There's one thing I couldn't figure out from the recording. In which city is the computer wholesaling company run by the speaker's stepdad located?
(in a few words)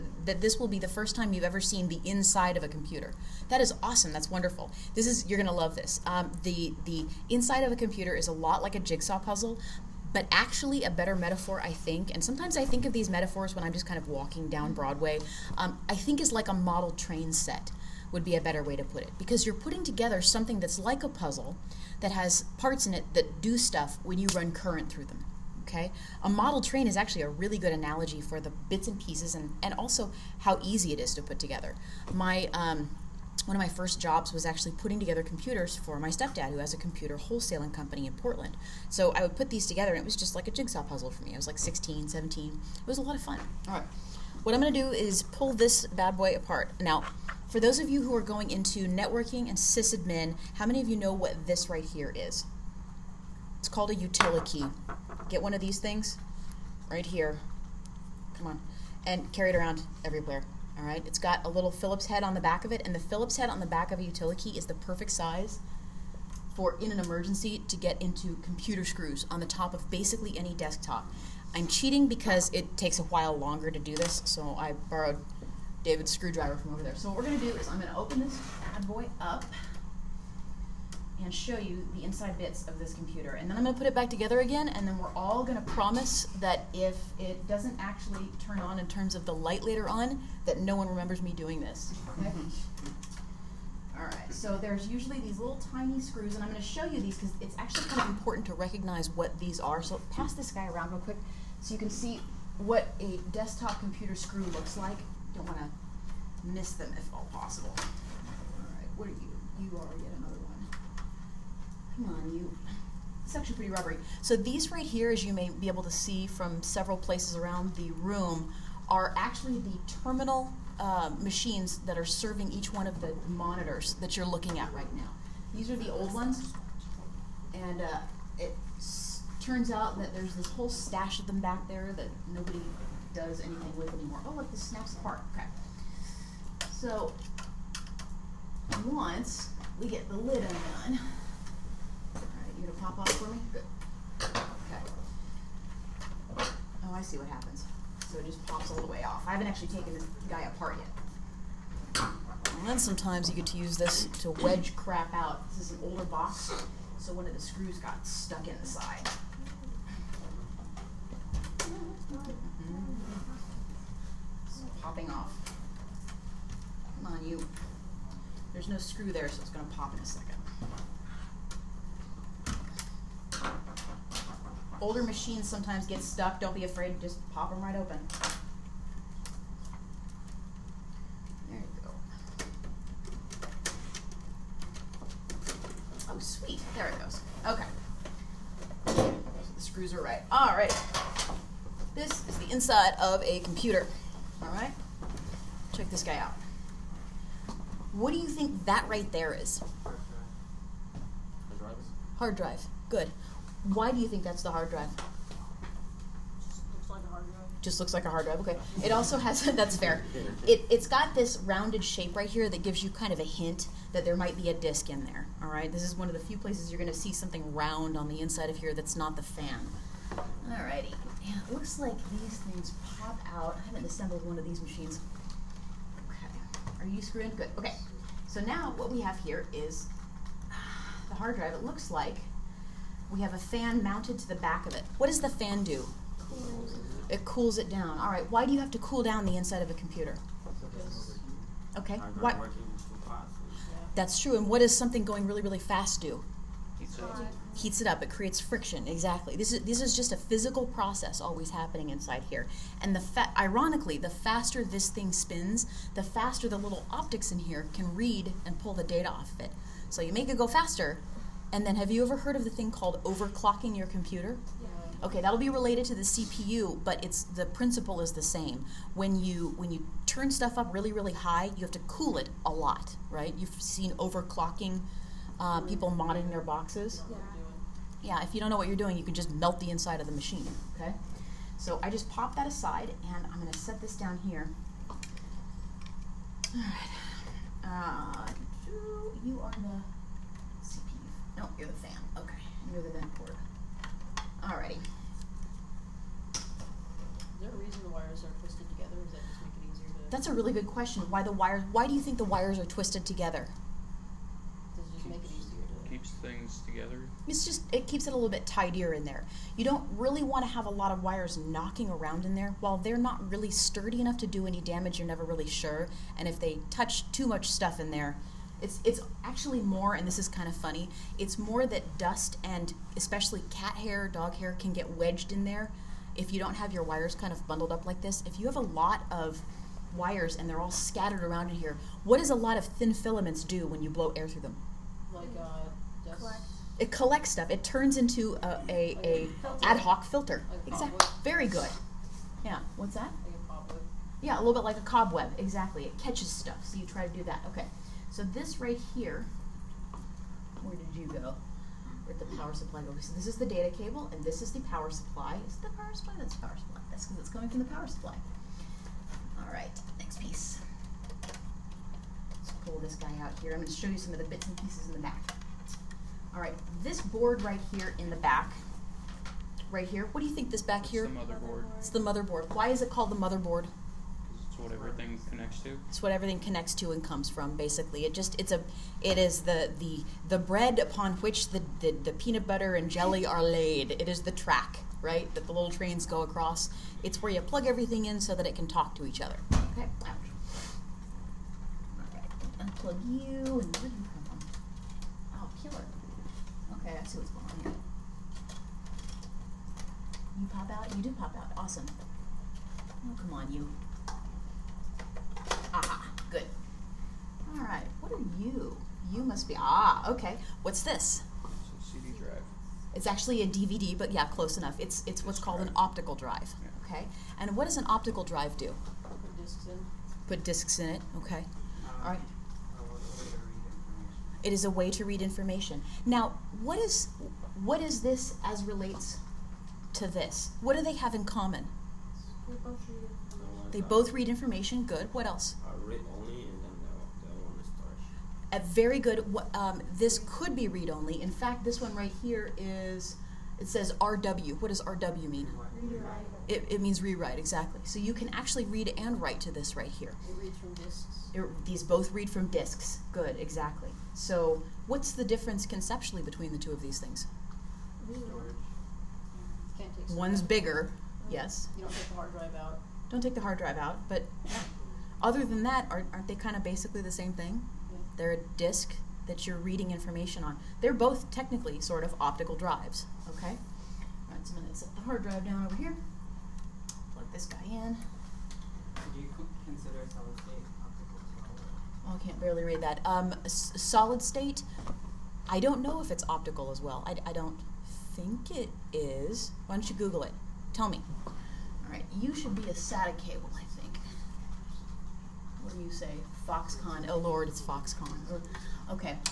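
Portland.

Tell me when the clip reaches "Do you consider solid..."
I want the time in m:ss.
7:58.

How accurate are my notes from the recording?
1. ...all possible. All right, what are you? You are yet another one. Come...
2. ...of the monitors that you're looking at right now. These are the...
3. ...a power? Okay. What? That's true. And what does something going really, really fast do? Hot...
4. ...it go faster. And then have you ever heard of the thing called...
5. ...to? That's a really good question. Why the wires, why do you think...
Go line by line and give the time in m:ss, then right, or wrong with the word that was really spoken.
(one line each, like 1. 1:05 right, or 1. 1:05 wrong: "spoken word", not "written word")
1. 1:47 right
2. 2:02 right
3. 3:59 wrong: "computer", not "power"
4. 4:20 right
5. 4:59 right.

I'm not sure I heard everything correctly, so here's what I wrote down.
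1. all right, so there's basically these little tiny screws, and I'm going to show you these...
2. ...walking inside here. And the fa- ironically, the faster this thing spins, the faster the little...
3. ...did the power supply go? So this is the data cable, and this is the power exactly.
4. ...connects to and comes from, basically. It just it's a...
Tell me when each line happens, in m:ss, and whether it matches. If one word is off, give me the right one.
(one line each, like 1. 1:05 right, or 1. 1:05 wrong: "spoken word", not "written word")
1. 1:33 wrong: "usually", not "basically"
2. 4:11 wrong: "happening", not "walking"
3. 5:52 wrong: "supply", not "exactly"
4. 6:16 right.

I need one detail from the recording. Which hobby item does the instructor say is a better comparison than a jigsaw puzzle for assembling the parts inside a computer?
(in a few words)
Model train set.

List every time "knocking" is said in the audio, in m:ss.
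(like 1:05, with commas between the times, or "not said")
5:11.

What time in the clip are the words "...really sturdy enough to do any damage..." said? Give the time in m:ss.
5:13.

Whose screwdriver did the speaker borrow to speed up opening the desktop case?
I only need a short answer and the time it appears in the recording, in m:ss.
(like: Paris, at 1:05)
David's, at 1:15.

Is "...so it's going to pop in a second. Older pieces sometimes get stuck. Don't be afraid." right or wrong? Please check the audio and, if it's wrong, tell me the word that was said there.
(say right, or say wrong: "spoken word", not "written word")
wrong: "machines", not "pieces".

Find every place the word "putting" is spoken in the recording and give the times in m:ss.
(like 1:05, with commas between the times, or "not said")
0:19, 0:34.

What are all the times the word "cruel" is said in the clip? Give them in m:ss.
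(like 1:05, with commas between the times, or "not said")
not said.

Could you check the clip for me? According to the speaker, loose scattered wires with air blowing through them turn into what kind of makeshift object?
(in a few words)
Ad hoc filter.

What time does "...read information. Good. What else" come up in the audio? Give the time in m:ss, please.
7:14.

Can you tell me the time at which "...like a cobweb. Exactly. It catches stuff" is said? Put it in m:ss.
5:44.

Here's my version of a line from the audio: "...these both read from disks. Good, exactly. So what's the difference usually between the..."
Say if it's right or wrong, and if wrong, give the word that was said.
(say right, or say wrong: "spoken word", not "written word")
wrong: "conceptually", not "usually".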